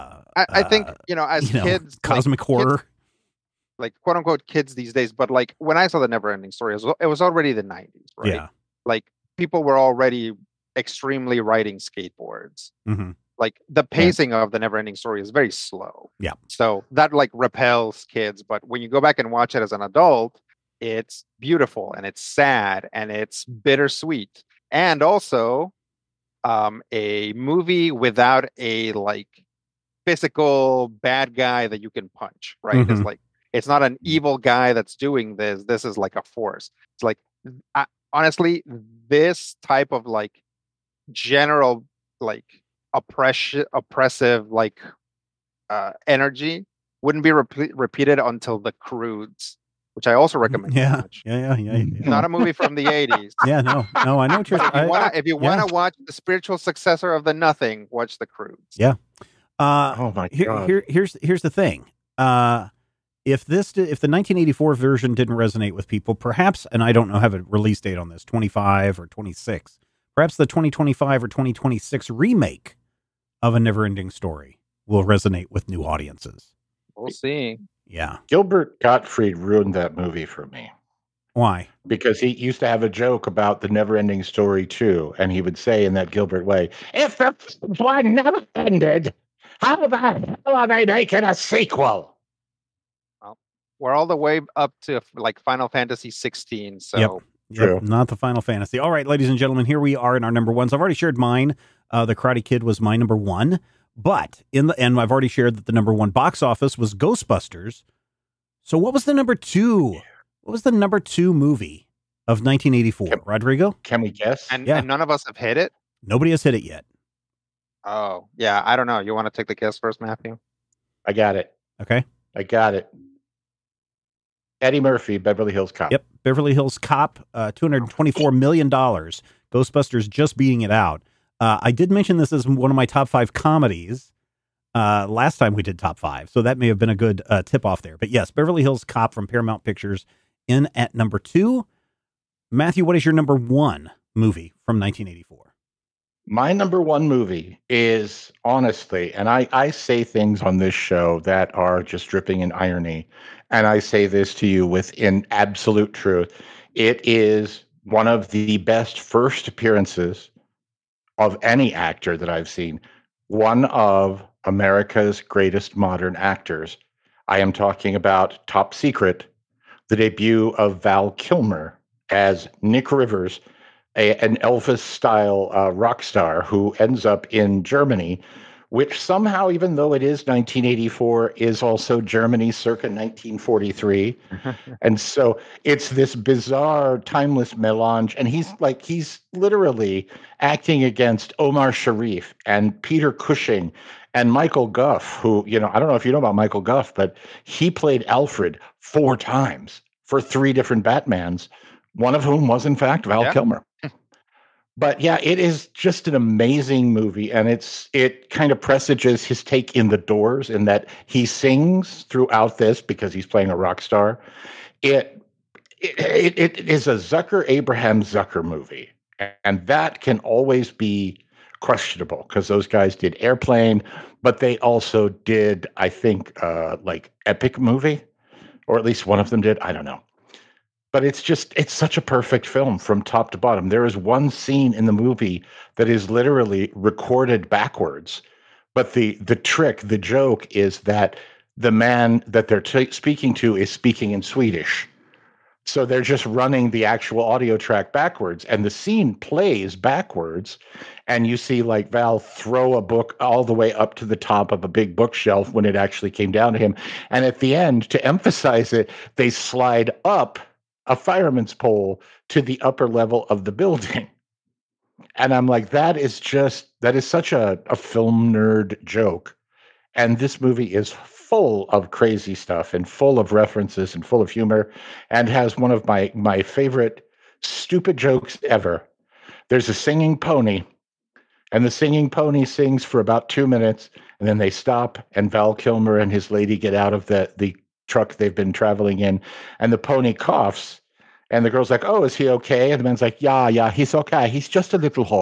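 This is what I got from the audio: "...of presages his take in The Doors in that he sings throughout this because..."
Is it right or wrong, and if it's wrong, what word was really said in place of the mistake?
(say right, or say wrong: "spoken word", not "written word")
right.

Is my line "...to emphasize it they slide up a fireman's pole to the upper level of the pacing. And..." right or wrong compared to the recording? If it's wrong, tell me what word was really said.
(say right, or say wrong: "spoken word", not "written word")
wrong: "building", not "pacing".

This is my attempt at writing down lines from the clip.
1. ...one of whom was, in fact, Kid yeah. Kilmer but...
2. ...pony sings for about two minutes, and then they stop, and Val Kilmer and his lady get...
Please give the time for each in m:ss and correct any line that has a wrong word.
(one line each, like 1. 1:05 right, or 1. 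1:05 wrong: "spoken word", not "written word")
1. 3:21 wrong: "Val", not "Kid"
2. 4:42 right.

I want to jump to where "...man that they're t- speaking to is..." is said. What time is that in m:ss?
4:01.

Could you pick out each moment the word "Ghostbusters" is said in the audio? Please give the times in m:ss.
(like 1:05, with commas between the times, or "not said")
1:46, 2:09.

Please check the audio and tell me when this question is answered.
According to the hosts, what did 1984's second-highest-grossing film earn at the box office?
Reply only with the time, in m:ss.
2:07.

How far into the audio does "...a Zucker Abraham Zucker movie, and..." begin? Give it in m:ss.
3:36.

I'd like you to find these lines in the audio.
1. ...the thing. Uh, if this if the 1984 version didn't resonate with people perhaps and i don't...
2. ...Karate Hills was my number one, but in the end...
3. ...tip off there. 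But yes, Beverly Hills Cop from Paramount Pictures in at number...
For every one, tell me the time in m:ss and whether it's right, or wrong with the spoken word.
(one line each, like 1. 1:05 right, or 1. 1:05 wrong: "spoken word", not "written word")
1. 1:01 right
2. 1:42 wrong: "Kid", not "Hills"
3. 2:17 right.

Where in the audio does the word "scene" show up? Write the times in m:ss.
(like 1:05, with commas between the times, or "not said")
3:54, 4:08.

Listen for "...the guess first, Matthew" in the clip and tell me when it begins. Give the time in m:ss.
1:59.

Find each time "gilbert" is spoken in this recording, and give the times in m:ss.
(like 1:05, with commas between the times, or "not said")
1:18, 1:26.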